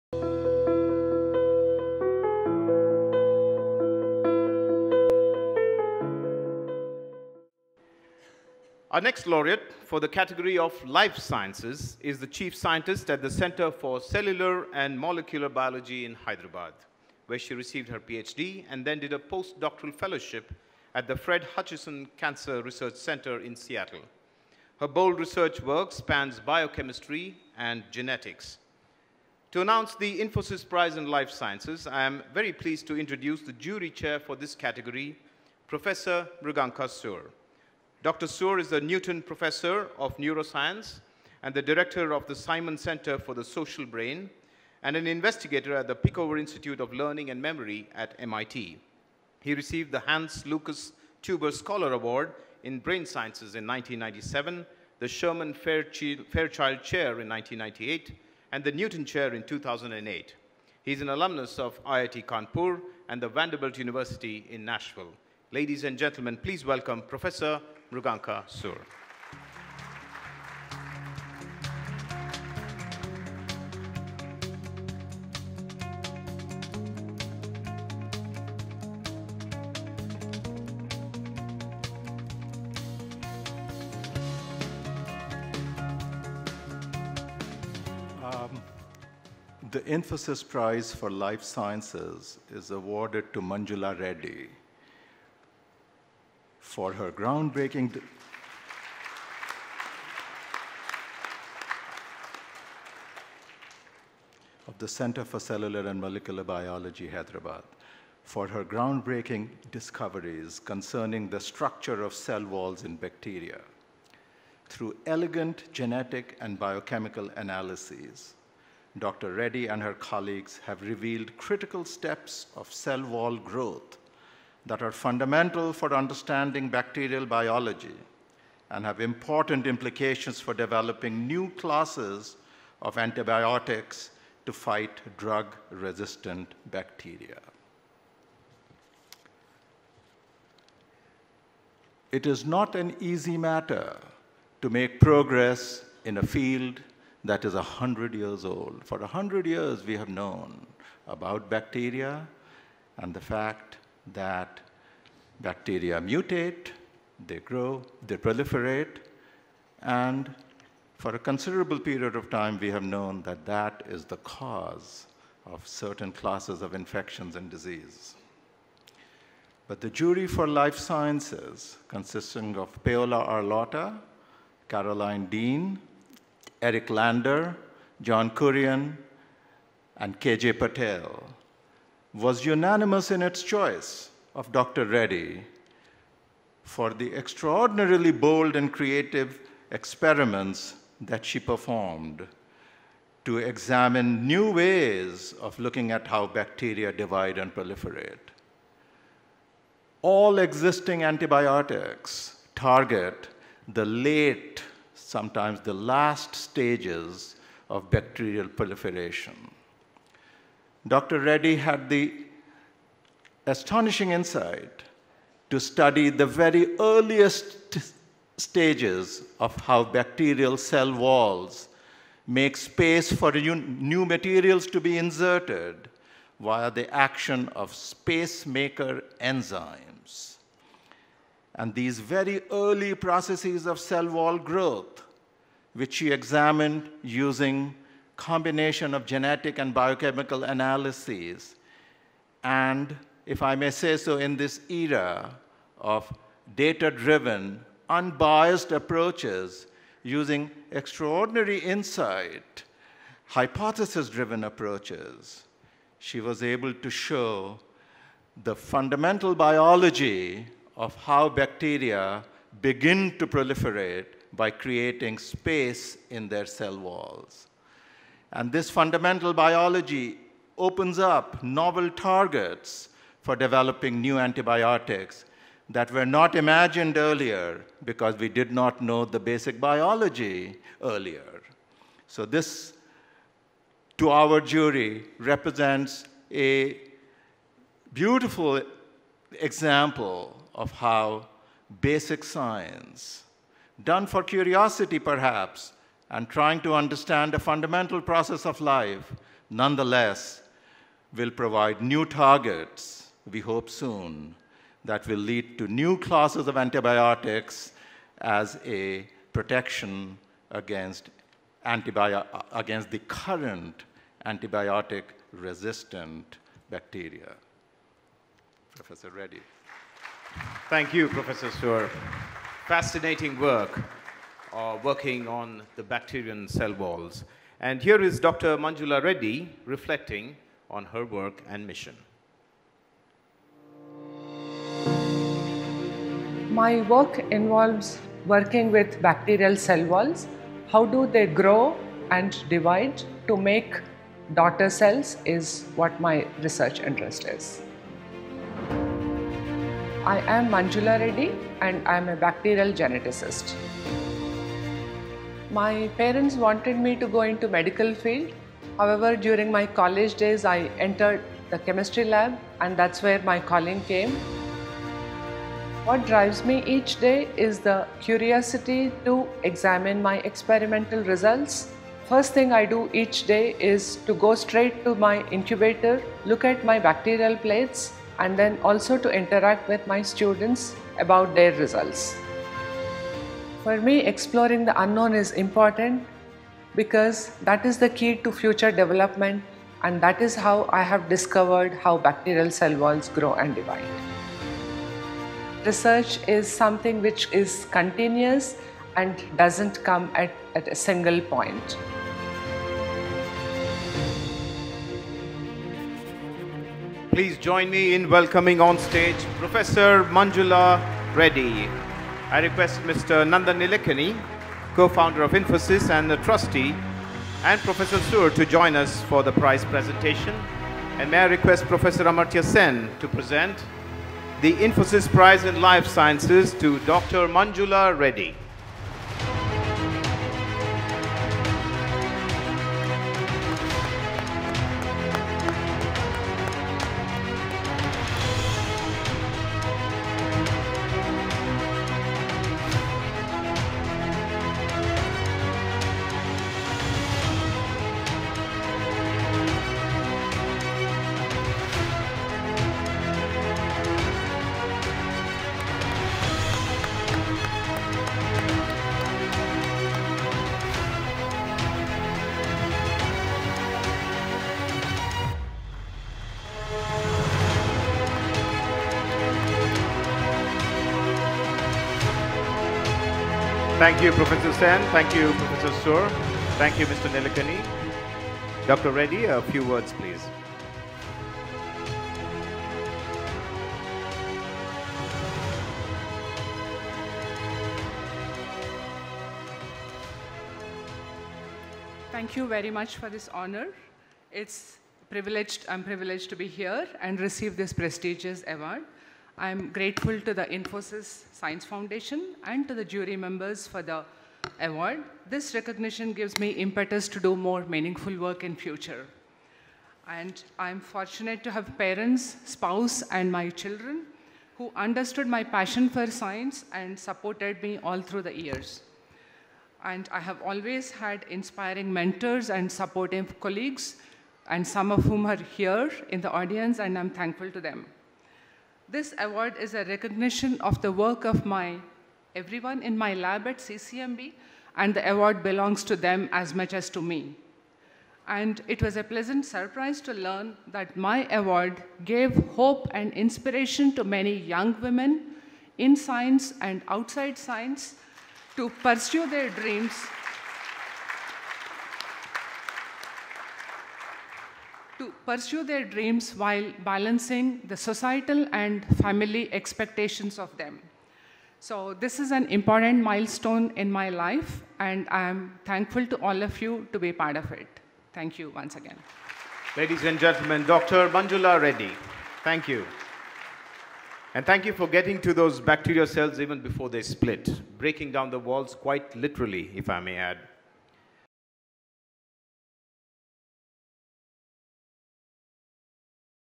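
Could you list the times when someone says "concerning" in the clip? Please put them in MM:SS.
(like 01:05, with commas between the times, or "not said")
01:50.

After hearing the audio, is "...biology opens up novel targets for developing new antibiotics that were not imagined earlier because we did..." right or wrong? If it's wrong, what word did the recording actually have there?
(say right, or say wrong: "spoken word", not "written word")
right.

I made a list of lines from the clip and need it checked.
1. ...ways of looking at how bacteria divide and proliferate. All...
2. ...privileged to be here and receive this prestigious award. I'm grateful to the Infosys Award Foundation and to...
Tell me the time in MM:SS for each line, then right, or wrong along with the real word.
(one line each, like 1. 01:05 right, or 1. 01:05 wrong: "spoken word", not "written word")
1. 03:14 right
2. 08:15 wrong: "Science", not "Award".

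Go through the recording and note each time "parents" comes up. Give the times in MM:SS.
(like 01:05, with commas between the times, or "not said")
05:55, 08:31.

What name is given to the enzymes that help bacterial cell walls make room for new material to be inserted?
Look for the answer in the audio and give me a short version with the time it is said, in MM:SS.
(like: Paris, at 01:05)
Space maker enzymes, at 03:47.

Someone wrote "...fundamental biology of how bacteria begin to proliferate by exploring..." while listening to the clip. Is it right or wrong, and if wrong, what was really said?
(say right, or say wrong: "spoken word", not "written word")
wrong: "creating", not "exploring".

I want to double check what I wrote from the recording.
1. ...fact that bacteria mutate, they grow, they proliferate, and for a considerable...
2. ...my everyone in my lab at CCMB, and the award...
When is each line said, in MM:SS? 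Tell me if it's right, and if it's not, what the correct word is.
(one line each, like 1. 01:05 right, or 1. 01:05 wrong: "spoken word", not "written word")
1. 02:33 right
2. 08:51 right.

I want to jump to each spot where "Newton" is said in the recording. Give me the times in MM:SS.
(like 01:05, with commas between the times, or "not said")
00:38, 00:58.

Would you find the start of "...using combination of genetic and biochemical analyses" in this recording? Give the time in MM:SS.
03:57.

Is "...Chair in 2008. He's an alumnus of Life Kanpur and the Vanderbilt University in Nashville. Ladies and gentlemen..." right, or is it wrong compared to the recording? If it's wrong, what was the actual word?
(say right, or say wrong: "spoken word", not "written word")
wrong: "IIT", not "Life".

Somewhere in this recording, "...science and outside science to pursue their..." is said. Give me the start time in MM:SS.
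09:05.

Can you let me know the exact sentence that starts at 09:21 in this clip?
So this is an important milestone in my life, and I am thankful to all of you to be part of it.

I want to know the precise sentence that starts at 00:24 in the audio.
Her bold research work spans biochemistry and genetics.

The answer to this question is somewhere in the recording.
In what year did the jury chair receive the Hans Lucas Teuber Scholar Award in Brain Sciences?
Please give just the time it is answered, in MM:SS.
00:53.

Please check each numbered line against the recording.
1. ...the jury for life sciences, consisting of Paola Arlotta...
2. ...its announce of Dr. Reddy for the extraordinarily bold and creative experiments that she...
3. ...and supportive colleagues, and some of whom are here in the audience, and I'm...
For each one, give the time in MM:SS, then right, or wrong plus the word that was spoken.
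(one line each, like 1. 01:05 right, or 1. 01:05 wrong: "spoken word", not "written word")
1. 02:49 right
2. 03:03 wrong: "choice", not "announce"
3. 08:42 right.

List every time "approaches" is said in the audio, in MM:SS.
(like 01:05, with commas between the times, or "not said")
04:08, 04:14.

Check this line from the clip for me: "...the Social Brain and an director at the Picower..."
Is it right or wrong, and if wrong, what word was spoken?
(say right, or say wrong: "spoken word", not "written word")
wrong: "investigator", not "director".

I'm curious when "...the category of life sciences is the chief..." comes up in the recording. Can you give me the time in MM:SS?
00:10.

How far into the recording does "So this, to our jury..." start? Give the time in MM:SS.
04:42.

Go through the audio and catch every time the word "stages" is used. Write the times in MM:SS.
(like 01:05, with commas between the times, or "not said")
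03:26, 03:38, 06:48.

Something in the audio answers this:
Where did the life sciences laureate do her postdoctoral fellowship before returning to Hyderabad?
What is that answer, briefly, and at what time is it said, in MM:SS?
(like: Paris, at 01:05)
Fred Hutchinson Cancer Research Center, at 00:21.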